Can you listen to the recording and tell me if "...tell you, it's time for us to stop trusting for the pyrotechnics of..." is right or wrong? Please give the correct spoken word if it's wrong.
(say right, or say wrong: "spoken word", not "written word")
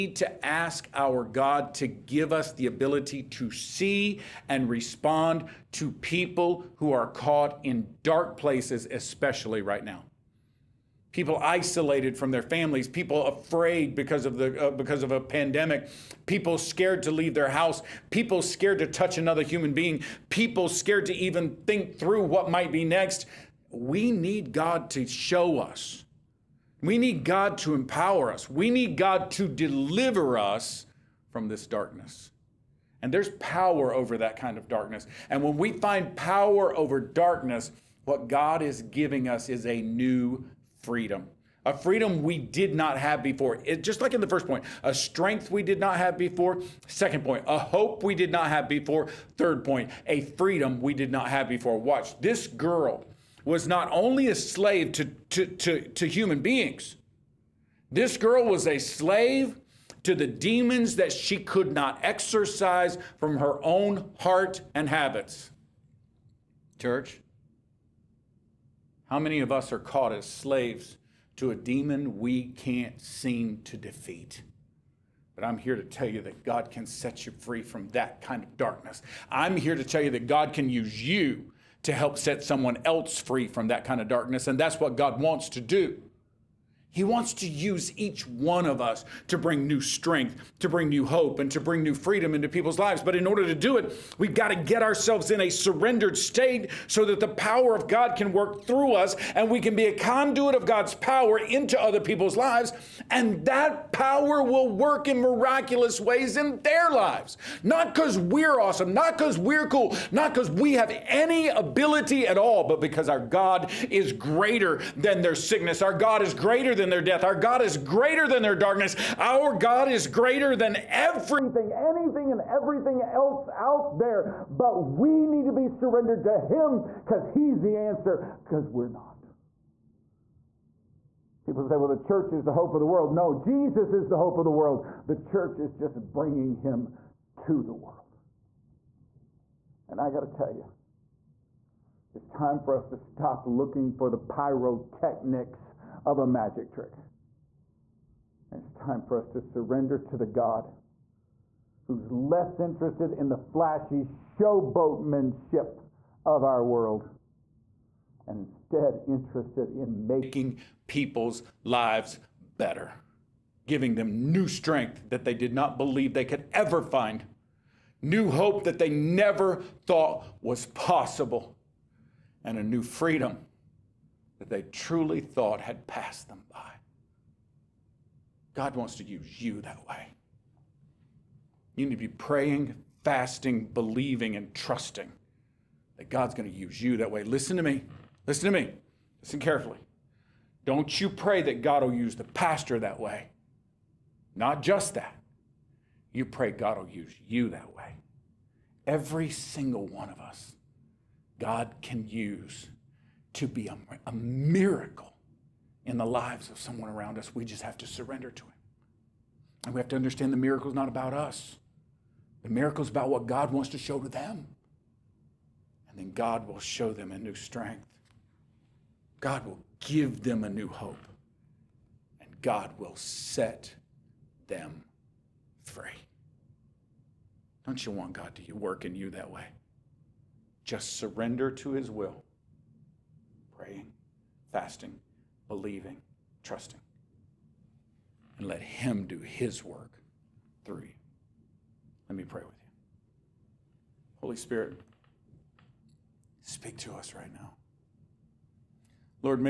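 wrong: "looking", not "trusting".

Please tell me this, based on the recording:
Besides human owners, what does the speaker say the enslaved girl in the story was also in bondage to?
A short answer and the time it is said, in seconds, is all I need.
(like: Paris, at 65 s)
Demons, at 60 s.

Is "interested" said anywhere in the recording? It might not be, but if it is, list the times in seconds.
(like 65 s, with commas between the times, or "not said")
152 s, 159 s.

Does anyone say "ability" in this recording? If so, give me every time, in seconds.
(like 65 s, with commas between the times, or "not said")
2 s, 111 s.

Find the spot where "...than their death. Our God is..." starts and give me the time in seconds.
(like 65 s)
116 s.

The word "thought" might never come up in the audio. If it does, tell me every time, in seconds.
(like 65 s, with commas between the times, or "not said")
169 s, 175 s.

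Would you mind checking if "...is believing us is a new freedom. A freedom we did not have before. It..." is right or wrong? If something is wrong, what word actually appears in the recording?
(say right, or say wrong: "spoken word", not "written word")
wrong: "giving", not "believing".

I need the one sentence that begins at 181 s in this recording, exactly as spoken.
You need to be praying, fasting, believing, and trusting that God's going to use you that way.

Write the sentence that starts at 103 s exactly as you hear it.
And that power will work in miraculous ways in their lives.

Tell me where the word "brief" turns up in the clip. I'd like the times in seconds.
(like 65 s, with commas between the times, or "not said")
not said.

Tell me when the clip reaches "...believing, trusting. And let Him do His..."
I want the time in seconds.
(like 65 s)
235 s.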